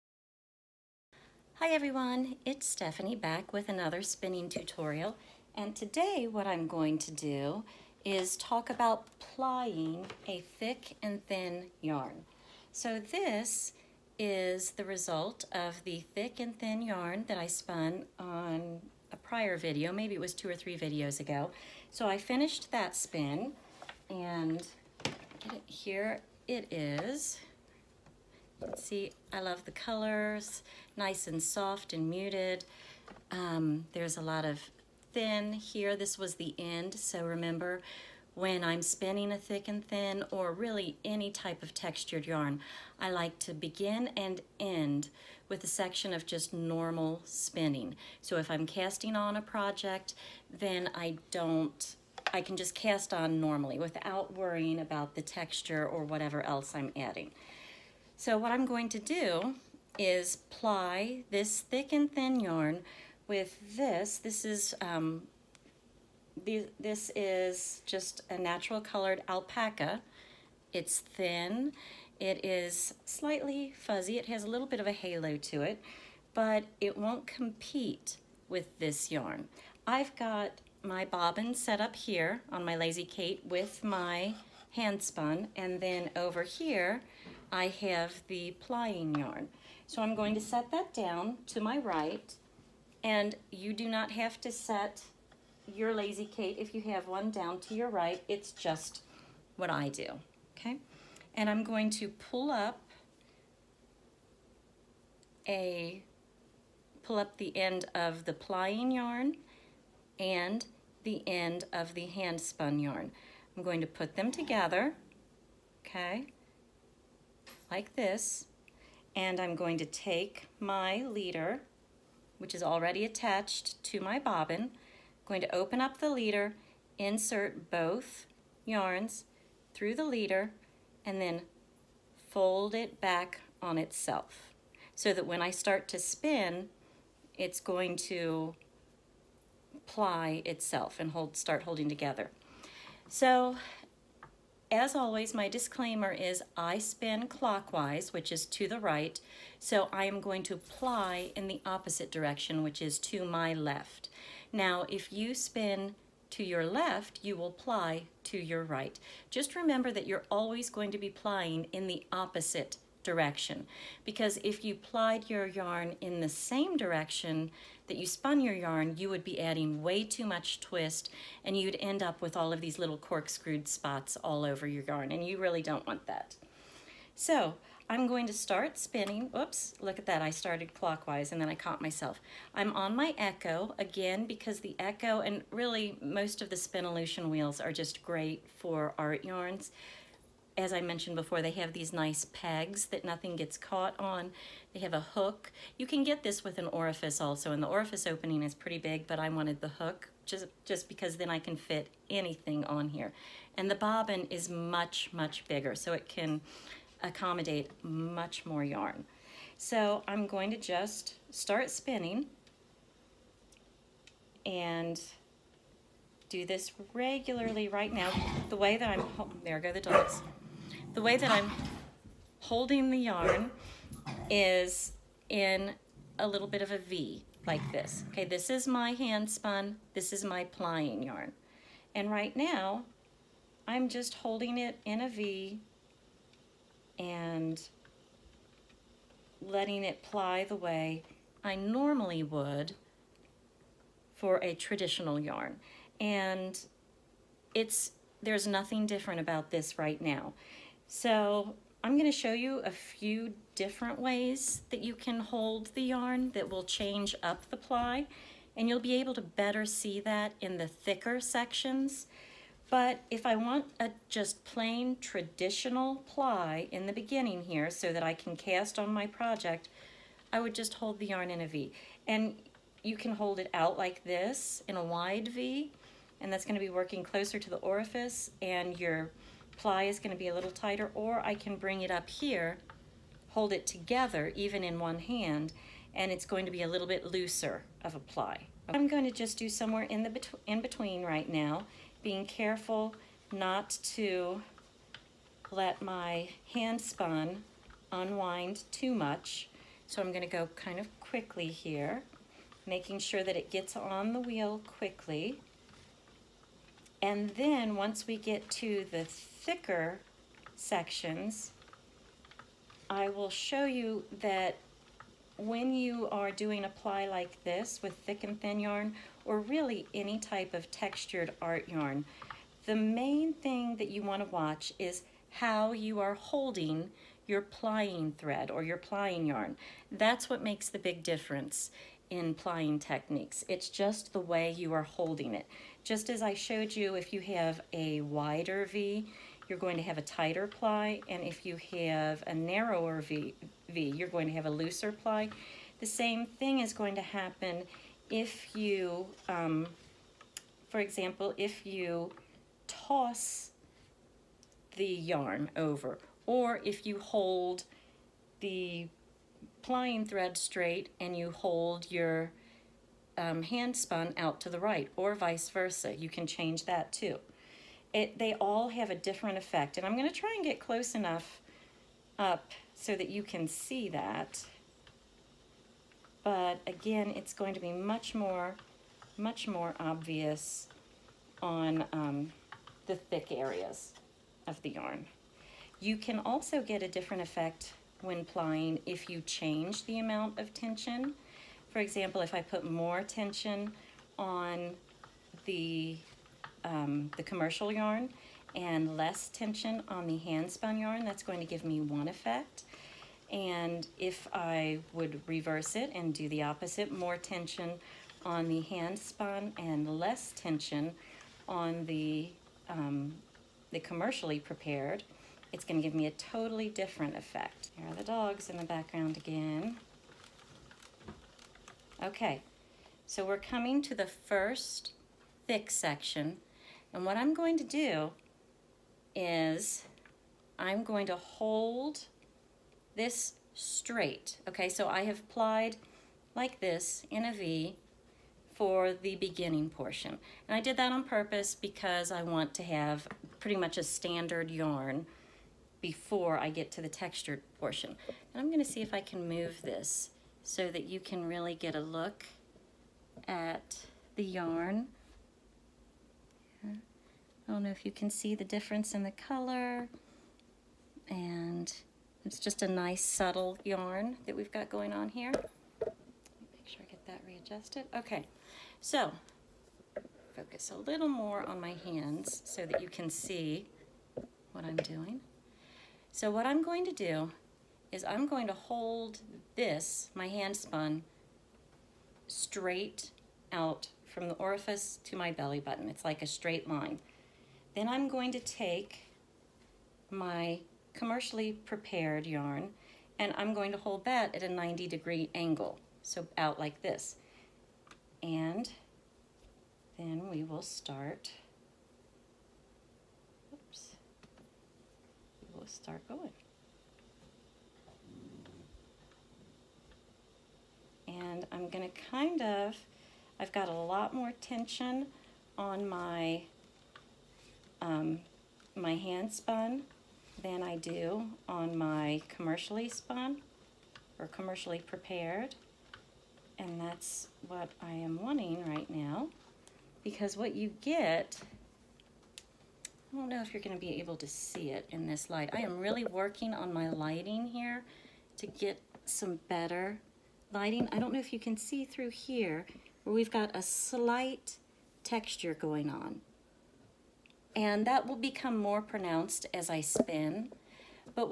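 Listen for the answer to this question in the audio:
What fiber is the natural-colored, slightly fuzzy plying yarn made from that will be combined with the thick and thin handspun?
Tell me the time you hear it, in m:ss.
1:09.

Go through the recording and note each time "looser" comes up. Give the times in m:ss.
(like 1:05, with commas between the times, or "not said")
4:47, 5:44.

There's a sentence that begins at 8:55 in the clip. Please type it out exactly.
I am really working on my lighting here to get some better lighting.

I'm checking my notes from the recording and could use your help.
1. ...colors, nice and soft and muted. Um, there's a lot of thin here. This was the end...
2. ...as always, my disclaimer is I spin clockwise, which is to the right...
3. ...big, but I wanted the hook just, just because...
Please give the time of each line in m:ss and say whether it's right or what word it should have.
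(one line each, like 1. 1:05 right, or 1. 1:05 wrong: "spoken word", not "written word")
1. 0:29 right
2. 2:24 right
3. 3:18 right.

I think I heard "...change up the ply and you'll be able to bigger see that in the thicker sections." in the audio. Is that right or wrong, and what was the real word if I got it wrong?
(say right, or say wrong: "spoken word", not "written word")
wrong: "better", not "bigger".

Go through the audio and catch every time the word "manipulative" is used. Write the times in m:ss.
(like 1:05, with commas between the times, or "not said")
not said.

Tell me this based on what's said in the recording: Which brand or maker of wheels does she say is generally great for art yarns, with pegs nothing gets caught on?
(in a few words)
Spinolution.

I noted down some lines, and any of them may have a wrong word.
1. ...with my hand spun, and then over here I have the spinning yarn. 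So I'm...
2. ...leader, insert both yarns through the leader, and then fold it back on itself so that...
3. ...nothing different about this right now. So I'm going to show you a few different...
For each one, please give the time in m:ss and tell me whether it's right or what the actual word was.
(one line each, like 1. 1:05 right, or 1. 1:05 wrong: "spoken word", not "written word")
1. 1:23 wrong: "plying", not "spinning"
2. 2:06 right
3. 4:08 right.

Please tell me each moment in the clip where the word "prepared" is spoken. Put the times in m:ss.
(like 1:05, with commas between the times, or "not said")
6:54, 8:11, 8:44.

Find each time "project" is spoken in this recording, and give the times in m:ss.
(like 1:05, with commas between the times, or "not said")
0:49, 4:29.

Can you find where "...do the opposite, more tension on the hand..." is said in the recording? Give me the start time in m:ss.
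6:46.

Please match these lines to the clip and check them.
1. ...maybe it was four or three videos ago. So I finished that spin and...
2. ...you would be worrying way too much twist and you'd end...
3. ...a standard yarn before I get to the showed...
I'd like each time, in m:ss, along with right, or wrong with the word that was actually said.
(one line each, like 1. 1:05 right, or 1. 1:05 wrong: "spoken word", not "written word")
1. 0:19 wrong: "two", not "four"
2. 2:48 wrong: "adding", not "worrying"
3. 7:23 wrong: "textured", not "showed".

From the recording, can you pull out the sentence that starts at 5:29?
That's what makes the big difference in plying techniques.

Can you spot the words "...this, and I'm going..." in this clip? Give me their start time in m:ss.
1:57.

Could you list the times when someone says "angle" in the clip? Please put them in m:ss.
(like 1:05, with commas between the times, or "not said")
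8:15.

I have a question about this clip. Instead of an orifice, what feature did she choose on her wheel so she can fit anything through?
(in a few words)
A hook.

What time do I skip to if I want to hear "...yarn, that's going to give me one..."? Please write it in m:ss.
6:40.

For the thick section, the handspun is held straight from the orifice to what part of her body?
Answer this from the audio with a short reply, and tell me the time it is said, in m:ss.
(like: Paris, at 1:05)
Belly button, at 8:05.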